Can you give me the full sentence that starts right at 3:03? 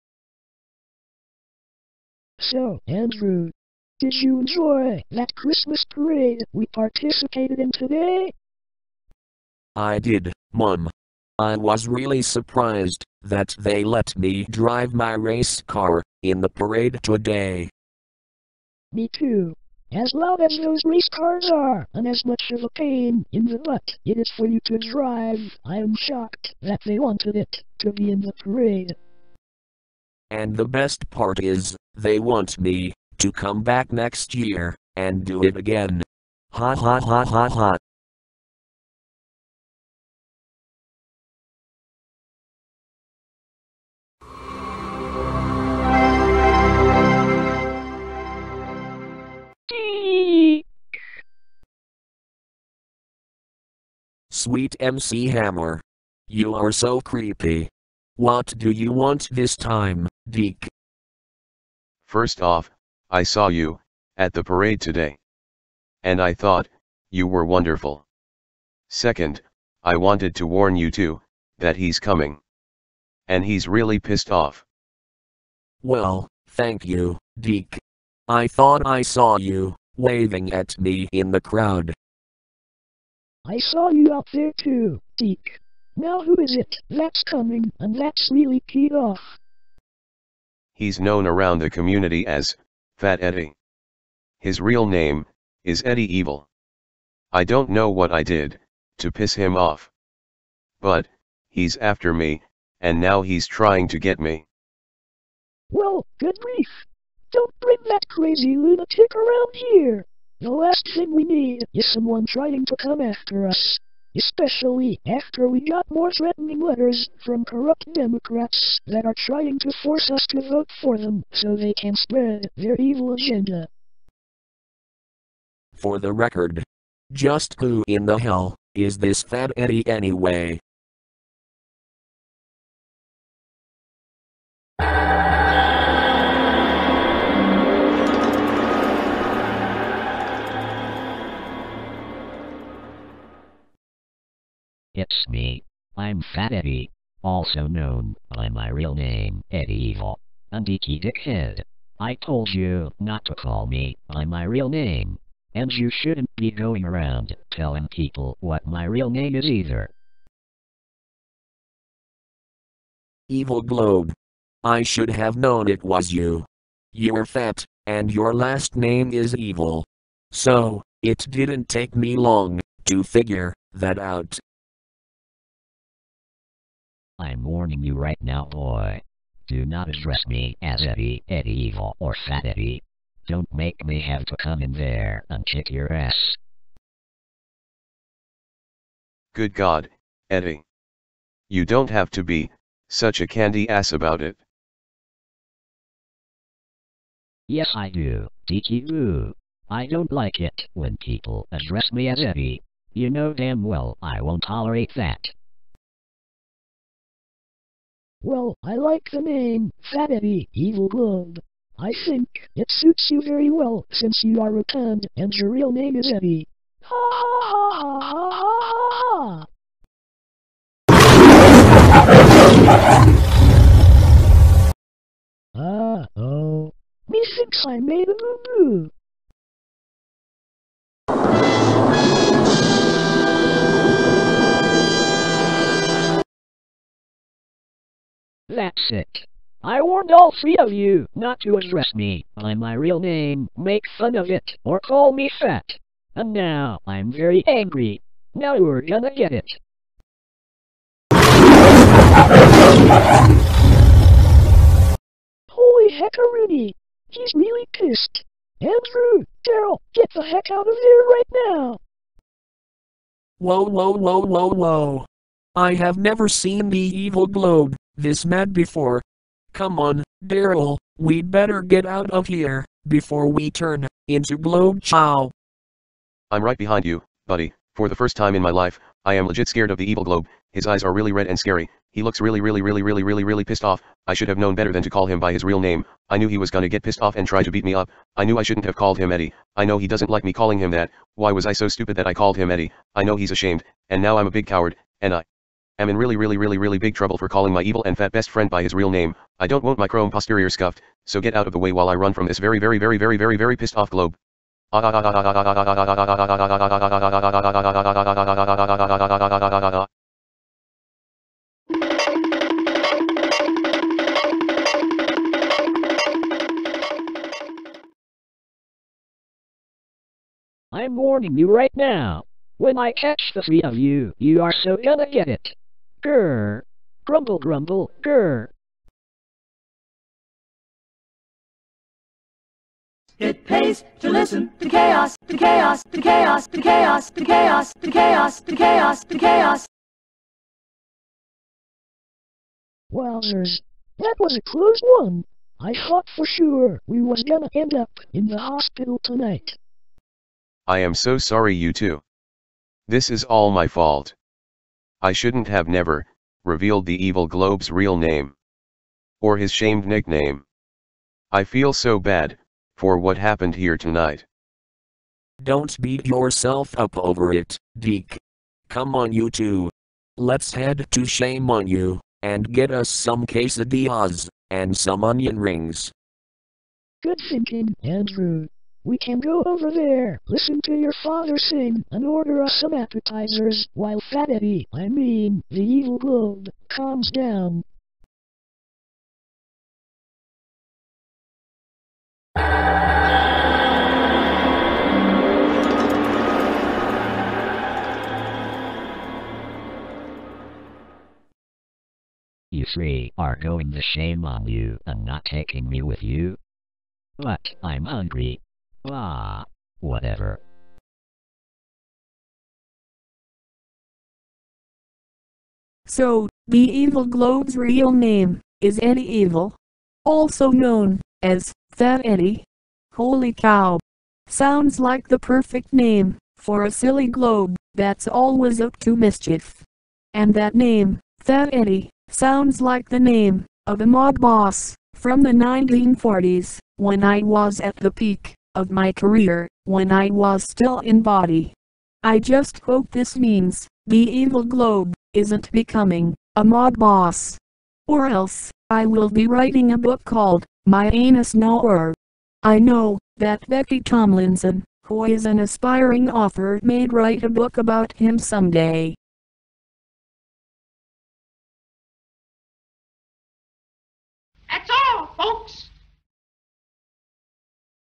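Don't make me have to come in there and kick your ass.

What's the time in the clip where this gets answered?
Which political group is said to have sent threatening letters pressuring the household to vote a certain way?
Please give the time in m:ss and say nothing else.
1:57.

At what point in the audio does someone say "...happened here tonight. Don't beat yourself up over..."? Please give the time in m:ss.
6:03.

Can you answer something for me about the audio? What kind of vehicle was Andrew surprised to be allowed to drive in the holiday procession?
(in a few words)
Race car.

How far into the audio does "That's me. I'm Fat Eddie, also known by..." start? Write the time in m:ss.
2:25.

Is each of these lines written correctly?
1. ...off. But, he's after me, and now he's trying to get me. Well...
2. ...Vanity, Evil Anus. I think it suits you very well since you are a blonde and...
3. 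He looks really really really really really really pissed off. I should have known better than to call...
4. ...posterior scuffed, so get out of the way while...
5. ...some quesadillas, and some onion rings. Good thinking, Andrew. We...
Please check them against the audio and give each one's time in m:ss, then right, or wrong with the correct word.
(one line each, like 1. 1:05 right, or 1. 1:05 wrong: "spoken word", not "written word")
1. 1:39 right
2. 3:29 wrong: "Blonde", not "Anus"
3. 4:41 right
4. 5:00 right
5. 6:12 right.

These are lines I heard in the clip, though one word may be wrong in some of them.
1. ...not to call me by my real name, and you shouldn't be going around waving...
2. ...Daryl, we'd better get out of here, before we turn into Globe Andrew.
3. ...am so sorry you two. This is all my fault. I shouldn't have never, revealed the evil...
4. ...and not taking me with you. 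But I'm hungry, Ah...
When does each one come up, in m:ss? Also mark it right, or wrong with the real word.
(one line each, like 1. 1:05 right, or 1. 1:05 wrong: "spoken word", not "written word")
1. 2:32 wrong: "telling", not "waving"
2. 4:30 wrong: "Chow", not "Andrew"
3. 5:50 right
4. 6:44 right.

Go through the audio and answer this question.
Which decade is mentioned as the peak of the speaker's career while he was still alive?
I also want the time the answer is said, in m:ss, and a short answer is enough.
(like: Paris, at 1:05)
1940s, at 7:15.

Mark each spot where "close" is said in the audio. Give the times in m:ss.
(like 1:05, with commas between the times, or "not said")
5:44.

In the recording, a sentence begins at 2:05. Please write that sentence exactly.
For the record, just who in the hell is this Fat Eddie anyway?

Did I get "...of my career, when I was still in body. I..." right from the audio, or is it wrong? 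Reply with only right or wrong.
right.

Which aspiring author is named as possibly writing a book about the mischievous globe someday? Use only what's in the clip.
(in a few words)
Becky Tomlinson.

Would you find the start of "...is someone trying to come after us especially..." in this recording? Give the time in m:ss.
1:51.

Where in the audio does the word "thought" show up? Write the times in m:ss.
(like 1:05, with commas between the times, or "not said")
1:06, 1:18, 5:45.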